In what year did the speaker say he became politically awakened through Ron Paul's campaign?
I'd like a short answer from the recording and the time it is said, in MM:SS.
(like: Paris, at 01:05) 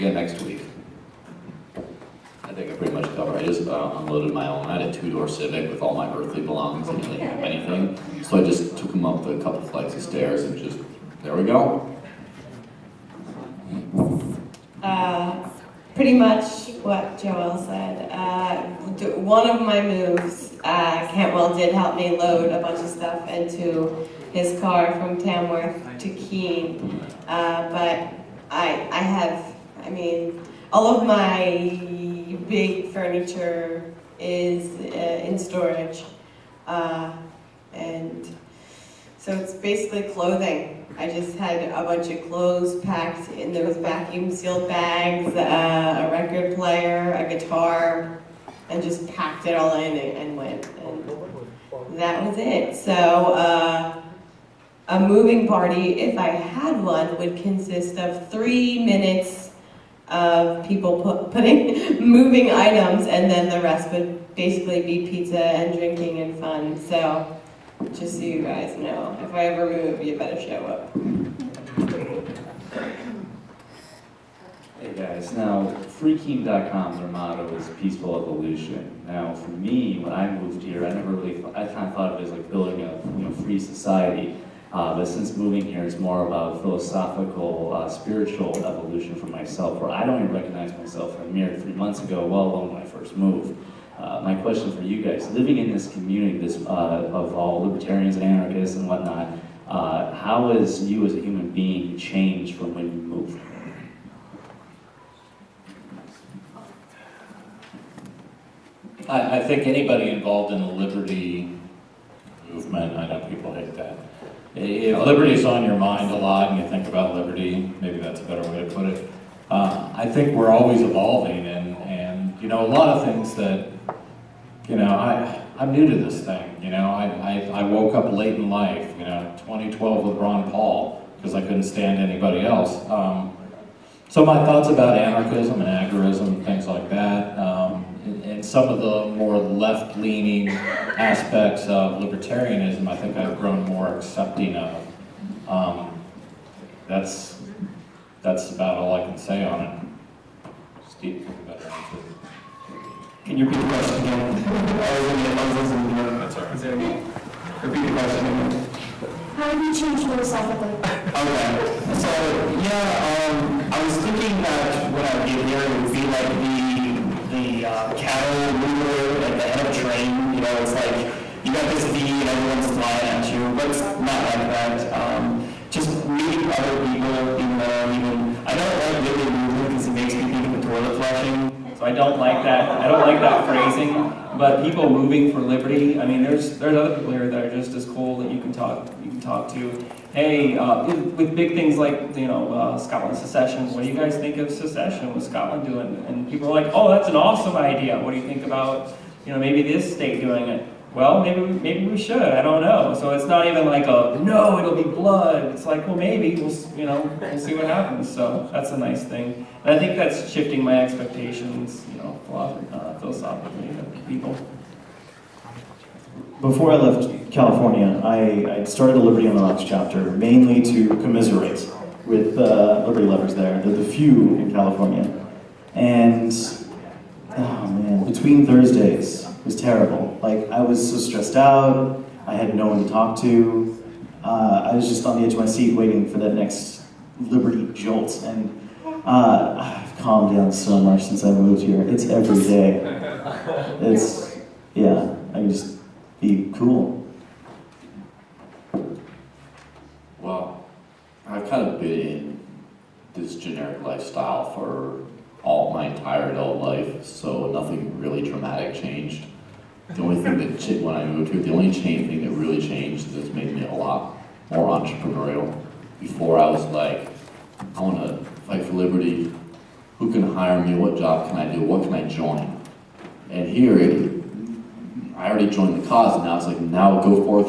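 2012, at 02:09.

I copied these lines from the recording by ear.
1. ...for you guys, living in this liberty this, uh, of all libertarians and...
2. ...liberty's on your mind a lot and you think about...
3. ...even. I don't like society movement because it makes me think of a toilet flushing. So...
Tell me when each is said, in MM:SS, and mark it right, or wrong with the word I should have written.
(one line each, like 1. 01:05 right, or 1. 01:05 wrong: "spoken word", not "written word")
1. 01:34 wrong: "community", not "liberty"
2. 01:55 right
3. 02:57 wrong: "liberty", not "society".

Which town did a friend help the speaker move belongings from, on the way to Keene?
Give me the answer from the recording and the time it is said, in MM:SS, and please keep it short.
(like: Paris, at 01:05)
Tamworth, at 00:25.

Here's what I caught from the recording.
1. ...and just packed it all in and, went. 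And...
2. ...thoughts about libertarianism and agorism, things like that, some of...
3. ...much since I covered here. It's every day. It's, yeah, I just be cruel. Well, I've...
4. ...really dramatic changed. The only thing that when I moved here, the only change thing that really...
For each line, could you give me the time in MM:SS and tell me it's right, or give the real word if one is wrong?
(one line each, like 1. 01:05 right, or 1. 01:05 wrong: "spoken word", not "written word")
1. 00:48 right
2. 02:14 wrong: "anarchism", not "libertarianism"
3. 04:00 wrong: "moved", not "covered"
4. 04:17 right.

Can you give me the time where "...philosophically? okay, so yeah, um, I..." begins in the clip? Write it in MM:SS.
02:40.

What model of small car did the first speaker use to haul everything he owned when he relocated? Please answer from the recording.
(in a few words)
Civic.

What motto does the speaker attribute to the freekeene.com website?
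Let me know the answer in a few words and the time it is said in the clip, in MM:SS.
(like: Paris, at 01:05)
peaceful evolution, at 01:17.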